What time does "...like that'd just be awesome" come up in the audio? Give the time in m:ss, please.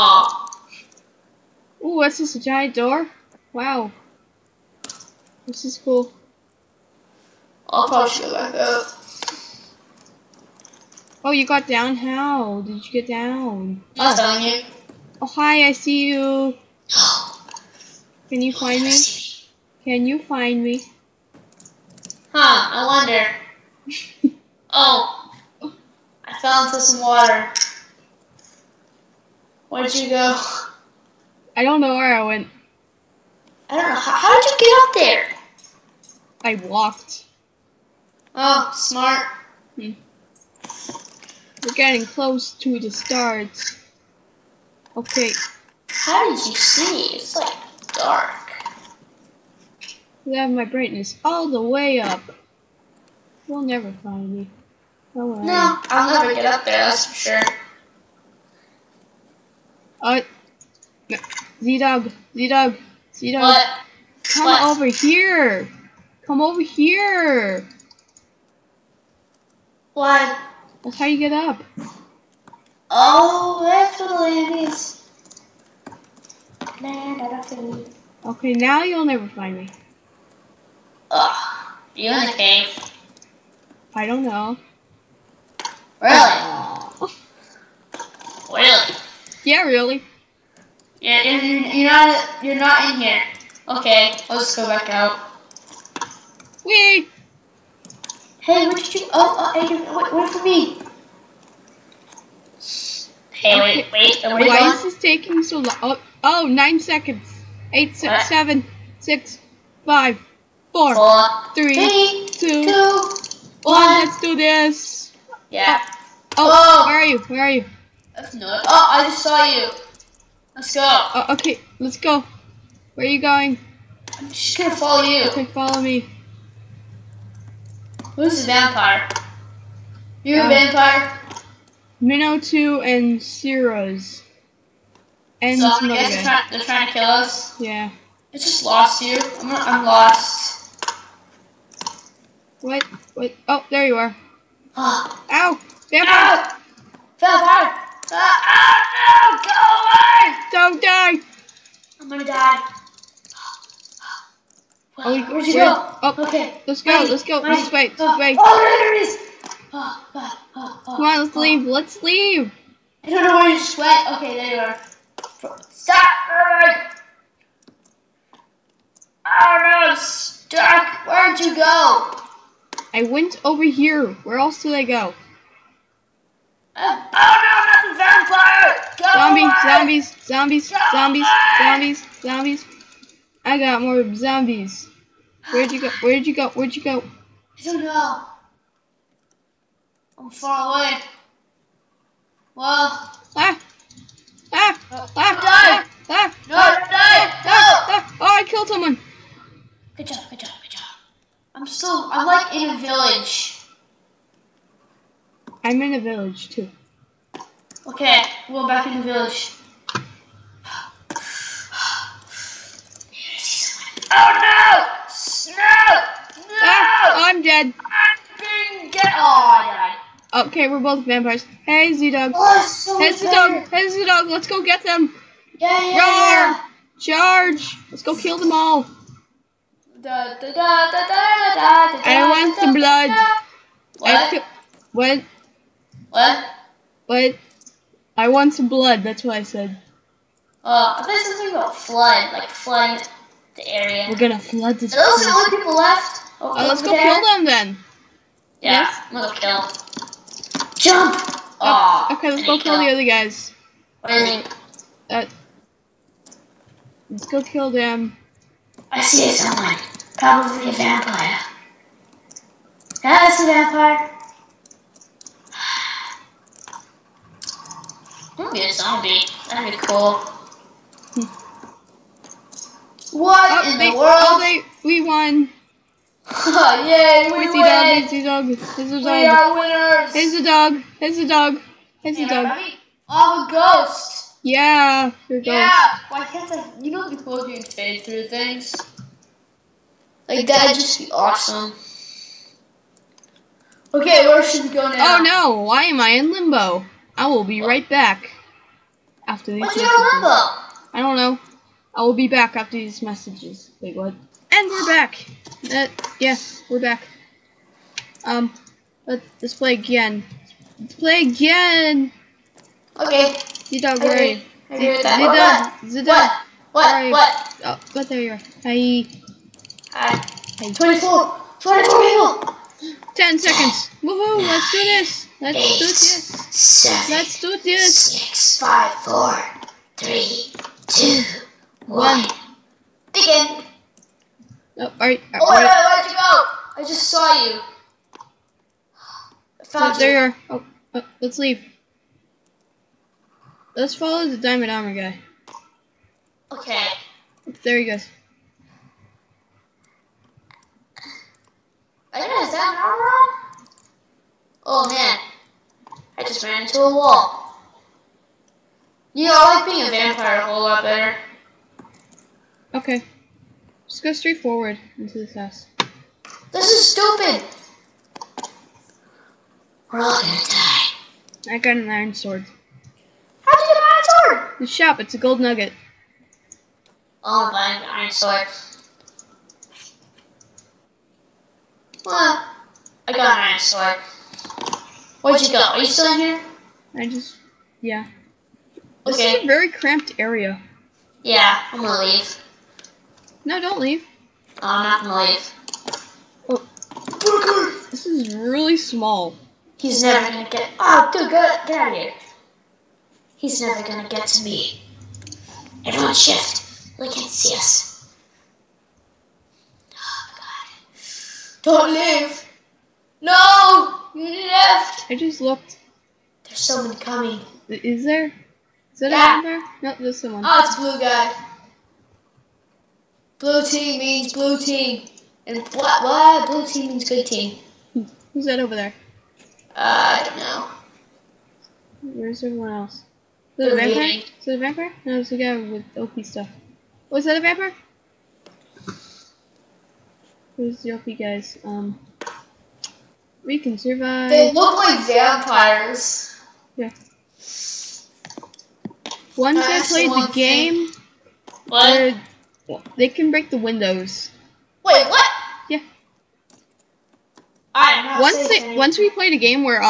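4:50.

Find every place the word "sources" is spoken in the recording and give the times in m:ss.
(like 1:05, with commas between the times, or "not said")
not said.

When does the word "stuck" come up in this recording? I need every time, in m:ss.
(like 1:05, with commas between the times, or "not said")
2:49.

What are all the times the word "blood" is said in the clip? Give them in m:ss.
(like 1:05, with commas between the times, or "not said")
3:52, 3:58.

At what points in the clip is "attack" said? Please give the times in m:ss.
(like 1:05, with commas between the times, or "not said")
not said.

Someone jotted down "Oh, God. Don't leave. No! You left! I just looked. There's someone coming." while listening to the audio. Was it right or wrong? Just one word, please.
right.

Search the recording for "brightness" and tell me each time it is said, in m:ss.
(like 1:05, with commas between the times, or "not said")
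0:50.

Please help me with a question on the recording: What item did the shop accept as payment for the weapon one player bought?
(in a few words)
gold nugget.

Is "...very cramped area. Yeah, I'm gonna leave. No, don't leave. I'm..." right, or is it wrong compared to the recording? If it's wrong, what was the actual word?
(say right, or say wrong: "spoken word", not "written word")
right.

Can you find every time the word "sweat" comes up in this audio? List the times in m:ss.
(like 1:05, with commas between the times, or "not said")
2:43.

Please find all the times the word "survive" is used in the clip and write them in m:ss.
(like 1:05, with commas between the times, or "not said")
7:23.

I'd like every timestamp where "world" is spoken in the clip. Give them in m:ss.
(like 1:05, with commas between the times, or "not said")
4:34.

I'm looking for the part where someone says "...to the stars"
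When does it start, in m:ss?
0:42.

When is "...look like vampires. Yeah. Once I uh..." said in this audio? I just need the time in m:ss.
7:24.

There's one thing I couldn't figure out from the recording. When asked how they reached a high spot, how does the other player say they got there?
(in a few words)
walked.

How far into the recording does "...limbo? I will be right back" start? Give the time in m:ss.
4:56.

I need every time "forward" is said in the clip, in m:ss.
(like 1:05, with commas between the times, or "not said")
6:04.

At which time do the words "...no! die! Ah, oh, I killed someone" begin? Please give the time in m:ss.
3:16.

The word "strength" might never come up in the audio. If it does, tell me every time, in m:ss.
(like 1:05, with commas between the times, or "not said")
not said.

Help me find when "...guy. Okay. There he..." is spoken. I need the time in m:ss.
5:44.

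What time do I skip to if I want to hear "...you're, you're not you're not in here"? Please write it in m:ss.
1:31.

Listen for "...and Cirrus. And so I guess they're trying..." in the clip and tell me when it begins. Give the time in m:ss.
2:12.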